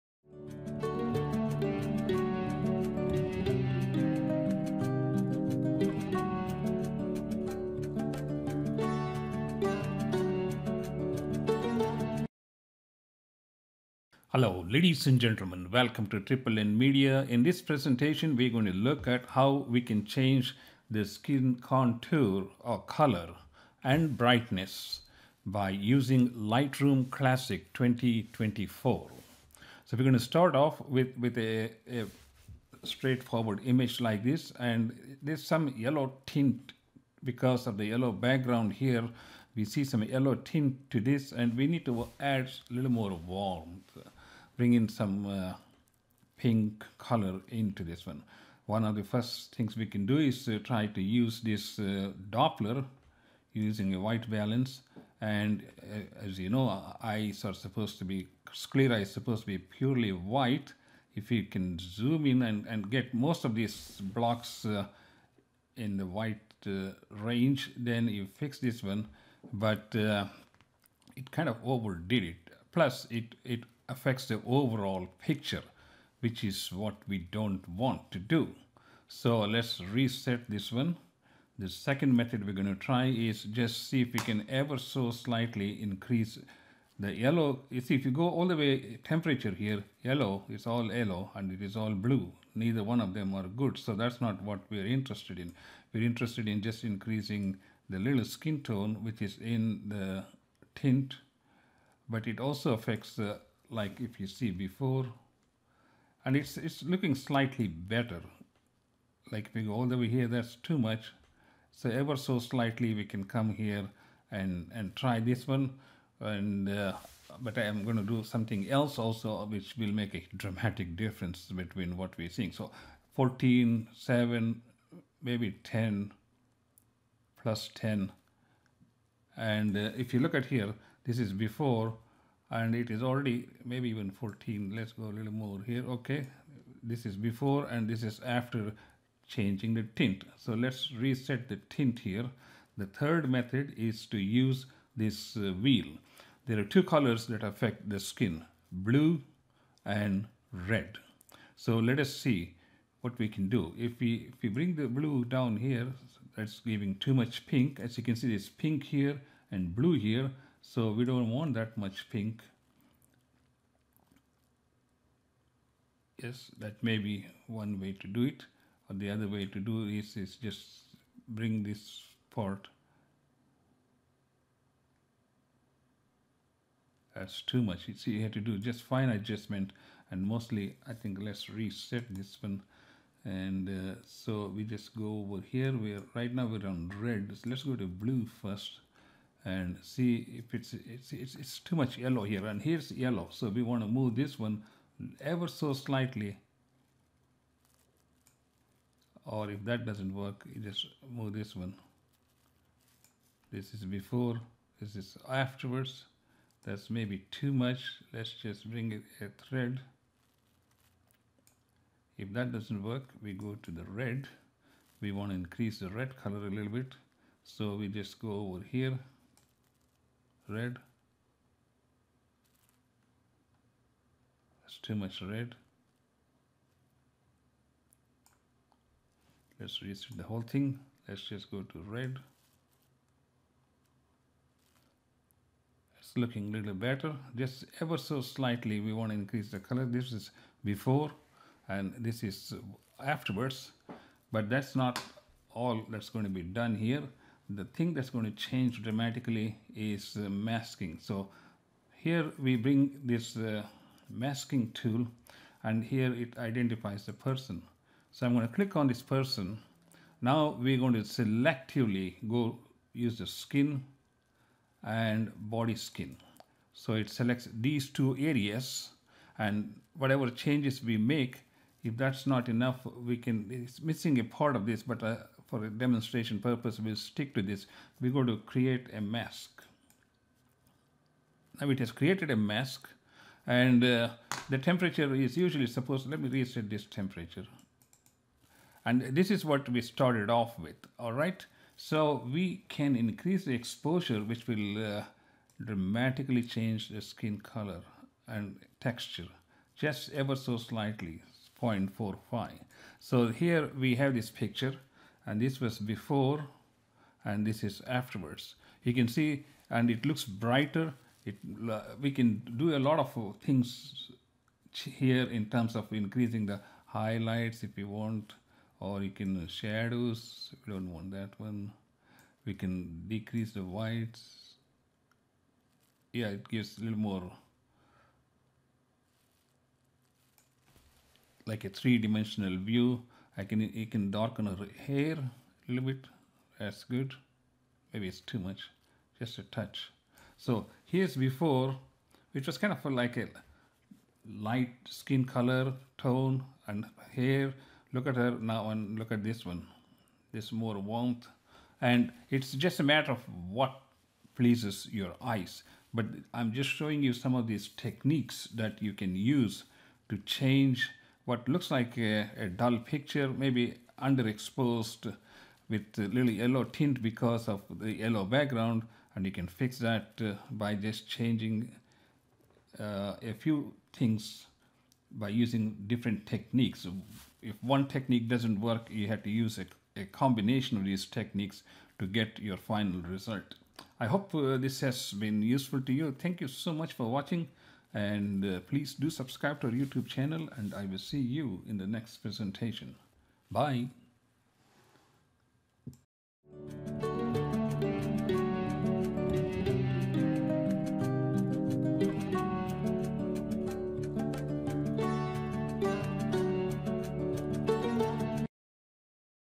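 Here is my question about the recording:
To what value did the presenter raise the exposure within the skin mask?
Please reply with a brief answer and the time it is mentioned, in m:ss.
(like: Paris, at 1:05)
0.45, at 5:01.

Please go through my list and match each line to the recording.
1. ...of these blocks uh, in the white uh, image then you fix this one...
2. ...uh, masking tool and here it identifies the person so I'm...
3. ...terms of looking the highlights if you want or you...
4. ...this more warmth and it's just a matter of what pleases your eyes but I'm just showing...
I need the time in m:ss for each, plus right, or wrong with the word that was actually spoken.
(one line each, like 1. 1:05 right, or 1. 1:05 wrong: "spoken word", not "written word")
1. 1:03 wrong: "range", not "image"
2. 4:13 right
3. 5:15 wrong: "increasing", not "looking"
4. 5:50 right.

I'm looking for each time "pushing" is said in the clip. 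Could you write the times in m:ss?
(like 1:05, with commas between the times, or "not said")
not said.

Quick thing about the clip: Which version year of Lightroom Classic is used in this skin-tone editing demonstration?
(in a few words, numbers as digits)
2024.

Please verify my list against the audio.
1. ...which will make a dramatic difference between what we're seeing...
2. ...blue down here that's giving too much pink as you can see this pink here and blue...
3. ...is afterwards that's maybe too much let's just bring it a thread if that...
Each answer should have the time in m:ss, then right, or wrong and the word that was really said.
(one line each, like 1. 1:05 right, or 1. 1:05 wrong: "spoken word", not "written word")
1. 1:59 right
2. 2:34 right
3. 3:24 right.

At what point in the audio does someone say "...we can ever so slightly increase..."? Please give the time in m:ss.
1:24.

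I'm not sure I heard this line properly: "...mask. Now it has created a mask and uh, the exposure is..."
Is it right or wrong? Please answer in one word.
wrong.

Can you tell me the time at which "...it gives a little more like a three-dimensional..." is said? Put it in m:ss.
5:26.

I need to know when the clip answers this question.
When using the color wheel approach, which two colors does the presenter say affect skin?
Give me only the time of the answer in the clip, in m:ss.
2:28.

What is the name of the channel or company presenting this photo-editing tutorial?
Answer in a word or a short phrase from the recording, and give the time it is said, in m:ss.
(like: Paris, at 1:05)
Triple N Media, at 0:16.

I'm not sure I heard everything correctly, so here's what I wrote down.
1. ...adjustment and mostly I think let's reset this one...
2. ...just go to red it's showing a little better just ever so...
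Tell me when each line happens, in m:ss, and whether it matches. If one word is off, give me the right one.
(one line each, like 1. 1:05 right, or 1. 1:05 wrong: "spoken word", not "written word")
1. 2:59 right
2. 3:51 wrong: "looking", not "showing".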